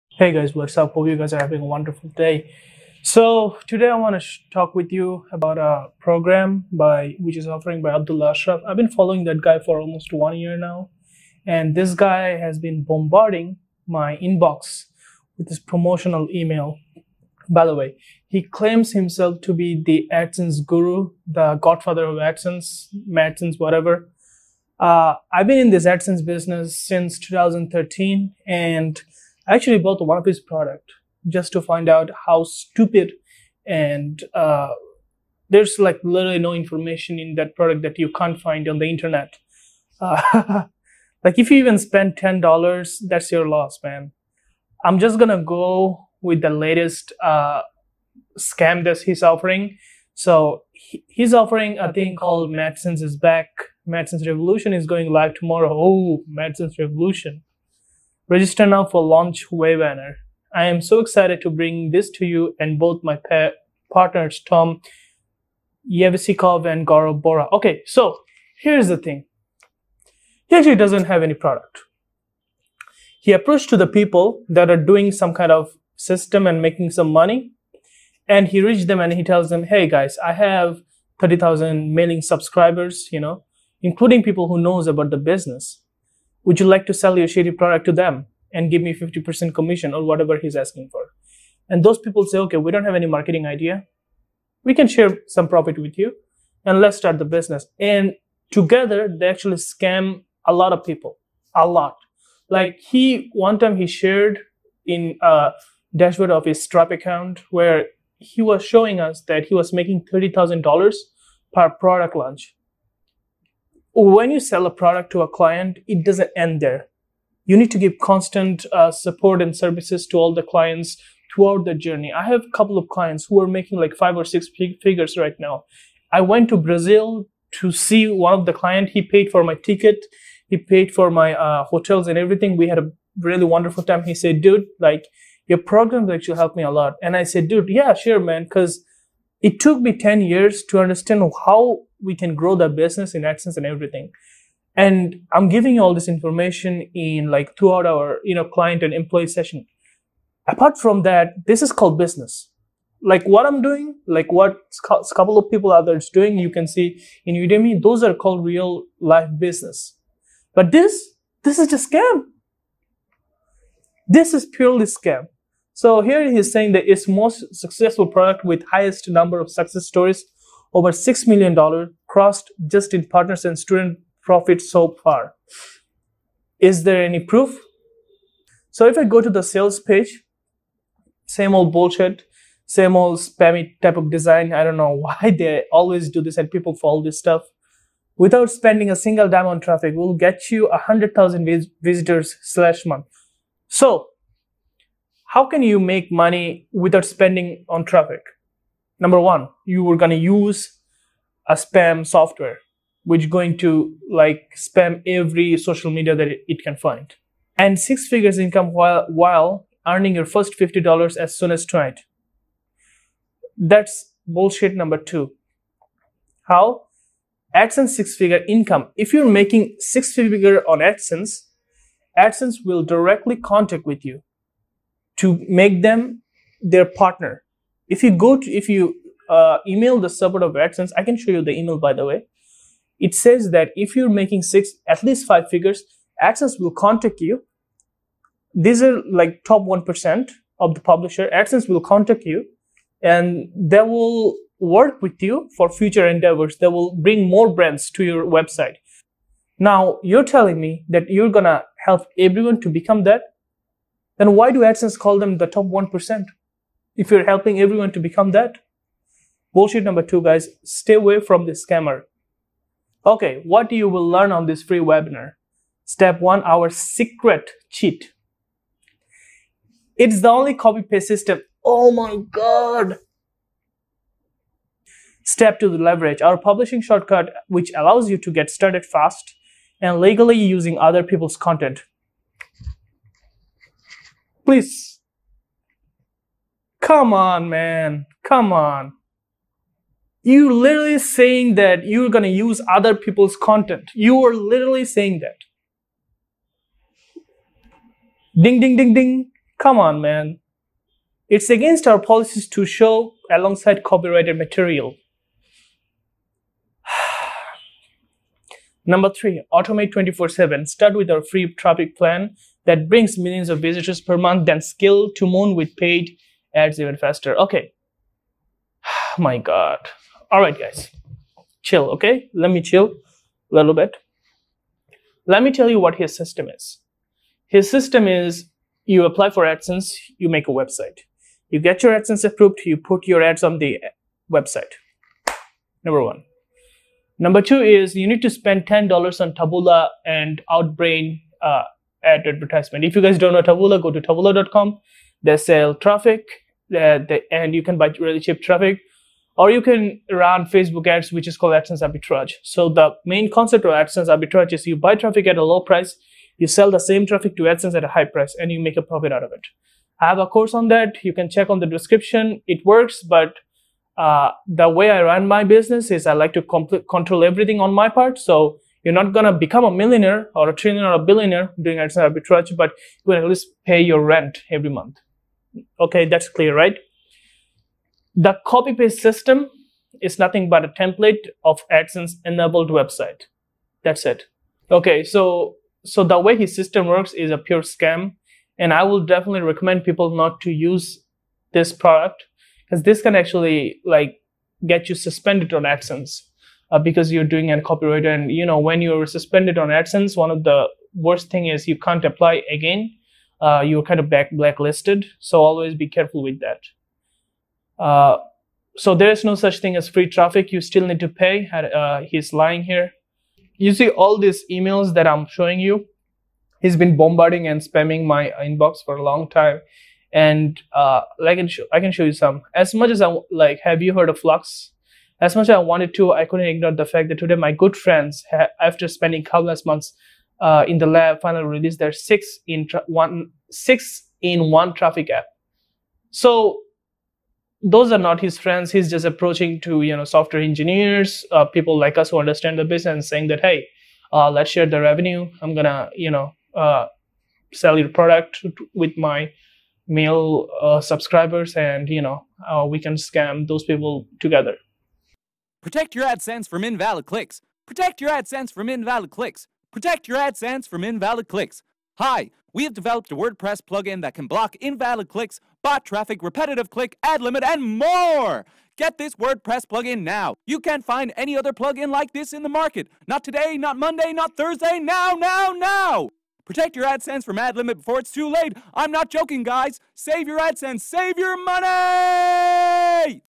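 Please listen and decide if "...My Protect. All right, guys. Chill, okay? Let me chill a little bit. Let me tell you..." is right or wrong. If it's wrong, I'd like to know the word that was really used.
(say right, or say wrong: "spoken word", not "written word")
wrong: "God", not "Protect".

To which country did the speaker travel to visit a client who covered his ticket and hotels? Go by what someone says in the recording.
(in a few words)
Brazil.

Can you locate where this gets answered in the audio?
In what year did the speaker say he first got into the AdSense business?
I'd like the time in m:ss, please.
0:27.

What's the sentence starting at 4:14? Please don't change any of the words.
Then why do AdSense call them the top one percent?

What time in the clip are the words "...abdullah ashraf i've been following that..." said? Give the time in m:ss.
0:07.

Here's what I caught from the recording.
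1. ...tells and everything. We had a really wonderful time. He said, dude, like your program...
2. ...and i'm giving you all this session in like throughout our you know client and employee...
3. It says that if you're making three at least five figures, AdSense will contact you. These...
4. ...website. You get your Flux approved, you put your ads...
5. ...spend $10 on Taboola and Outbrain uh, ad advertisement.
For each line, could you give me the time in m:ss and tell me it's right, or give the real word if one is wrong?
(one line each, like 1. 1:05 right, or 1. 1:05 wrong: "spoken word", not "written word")
1. 2:11 wrong: "hotels", not "tells"
2. 2:24 wrong: "information", not "session"
3. 3:53 wrong: "six", not "three"
4. 5:30 wrong: "AdSense", not "Flux"
5. 5:38 right.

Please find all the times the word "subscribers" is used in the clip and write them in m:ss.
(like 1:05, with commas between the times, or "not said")
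1:22, 7:30.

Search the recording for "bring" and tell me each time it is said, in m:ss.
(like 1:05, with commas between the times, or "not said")
1:01, 4:06, 5:12.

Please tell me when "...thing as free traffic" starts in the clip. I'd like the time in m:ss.
6:49.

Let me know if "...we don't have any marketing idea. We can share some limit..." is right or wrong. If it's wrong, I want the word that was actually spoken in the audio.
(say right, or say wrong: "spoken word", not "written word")
wrong: "profit", not "limit".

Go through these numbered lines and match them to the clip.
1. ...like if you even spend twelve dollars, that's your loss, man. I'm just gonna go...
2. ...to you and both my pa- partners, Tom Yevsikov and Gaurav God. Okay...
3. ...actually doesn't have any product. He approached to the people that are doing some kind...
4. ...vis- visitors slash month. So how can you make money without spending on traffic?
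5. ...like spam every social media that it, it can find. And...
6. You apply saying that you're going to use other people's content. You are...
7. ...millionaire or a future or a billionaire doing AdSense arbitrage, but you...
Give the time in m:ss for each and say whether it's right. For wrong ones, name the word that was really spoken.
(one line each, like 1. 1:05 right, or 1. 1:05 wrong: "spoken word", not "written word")
1. 0:41 wrong: "ten", not "twelve"
2. 1:02 wrong: "Bora", not "God"
3. 1:10 right
4. 3:11 right
5. 3:24 right
6. 4:50 wrong: "literally", not "apply"
7. 6:09 wrong: "trillionaire", not "future".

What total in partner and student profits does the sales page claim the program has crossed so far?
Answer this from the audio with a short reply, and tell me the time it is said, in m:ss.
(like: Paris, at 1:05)
$6 million, at 2:50.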